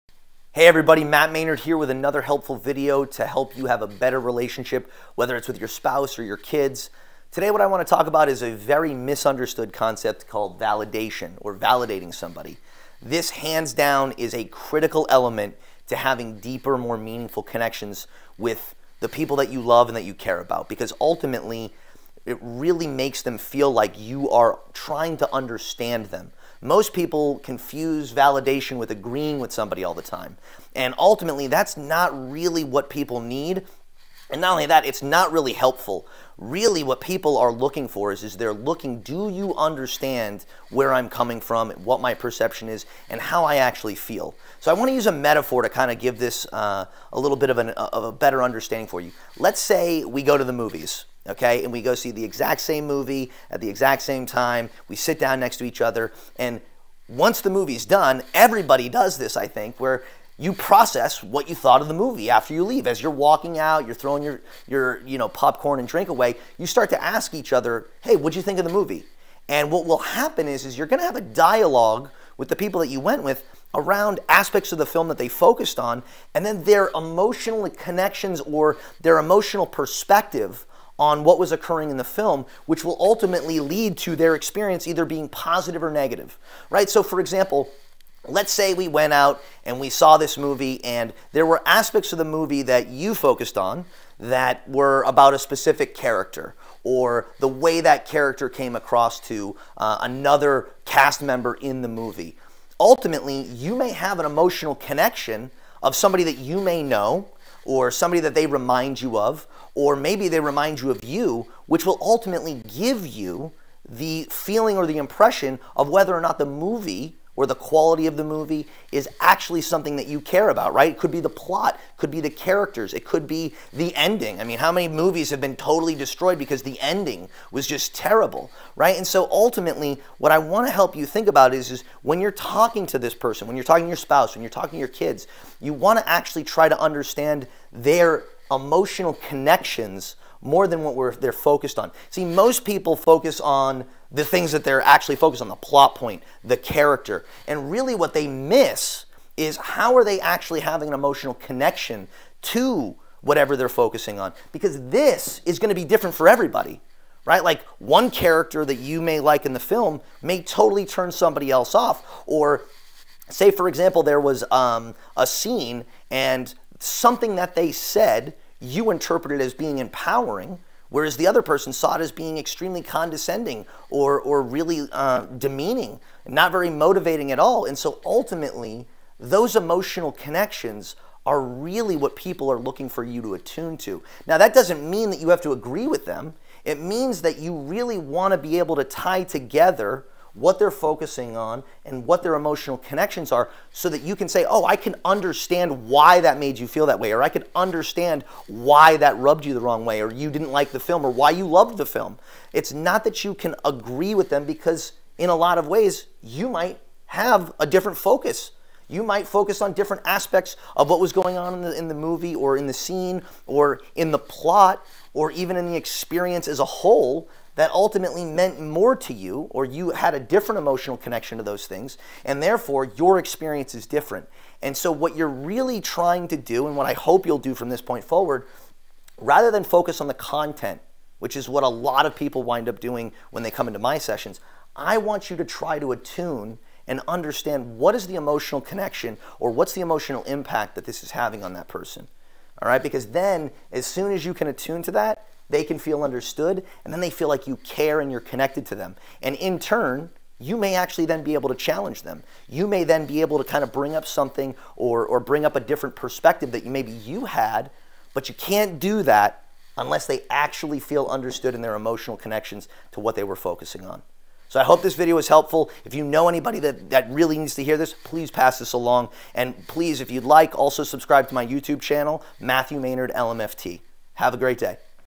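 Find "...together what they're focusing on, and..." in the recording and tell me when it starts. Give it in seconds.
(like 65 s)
189 s.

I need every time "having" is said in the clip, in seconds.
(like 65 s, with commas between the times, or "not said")
15 s, 150 s, 241 s.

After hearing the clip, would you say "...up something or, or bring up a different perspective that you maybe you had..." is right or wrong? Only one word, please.
right.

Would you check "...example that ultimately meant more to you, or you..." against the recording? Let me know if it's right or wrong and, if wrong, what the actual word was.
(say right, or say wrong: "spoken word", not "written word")
wrong: "whole", not "example".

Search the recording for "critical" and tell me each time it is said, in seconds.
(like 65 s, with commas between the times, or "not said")
14 s.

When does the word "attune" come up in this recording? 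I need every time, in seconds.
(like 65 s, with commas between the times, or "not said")
183 s, 235 s, 244 s.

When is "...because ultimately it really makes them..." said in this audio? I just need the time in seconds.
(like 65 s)
20 s.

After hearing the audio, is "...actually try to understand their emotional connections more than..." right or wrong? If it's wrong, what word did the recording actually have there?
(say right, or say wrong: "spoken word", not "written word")
right.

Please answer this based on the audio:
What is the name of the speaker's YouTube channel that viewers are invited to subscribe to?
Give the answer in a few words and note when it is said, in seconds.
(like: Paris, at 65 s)
Matthew Maynard LMFT, at 272 s.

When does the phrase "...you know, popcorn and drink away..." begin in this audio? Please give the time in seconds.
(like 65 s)
65 s.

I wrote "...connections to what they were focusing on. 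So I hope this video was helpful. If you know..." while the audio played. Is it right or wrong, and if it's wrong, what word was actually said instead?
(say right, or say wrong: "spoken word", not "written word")
right.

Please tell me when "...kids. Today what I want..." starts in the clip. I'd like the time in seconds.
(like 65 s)
6 s.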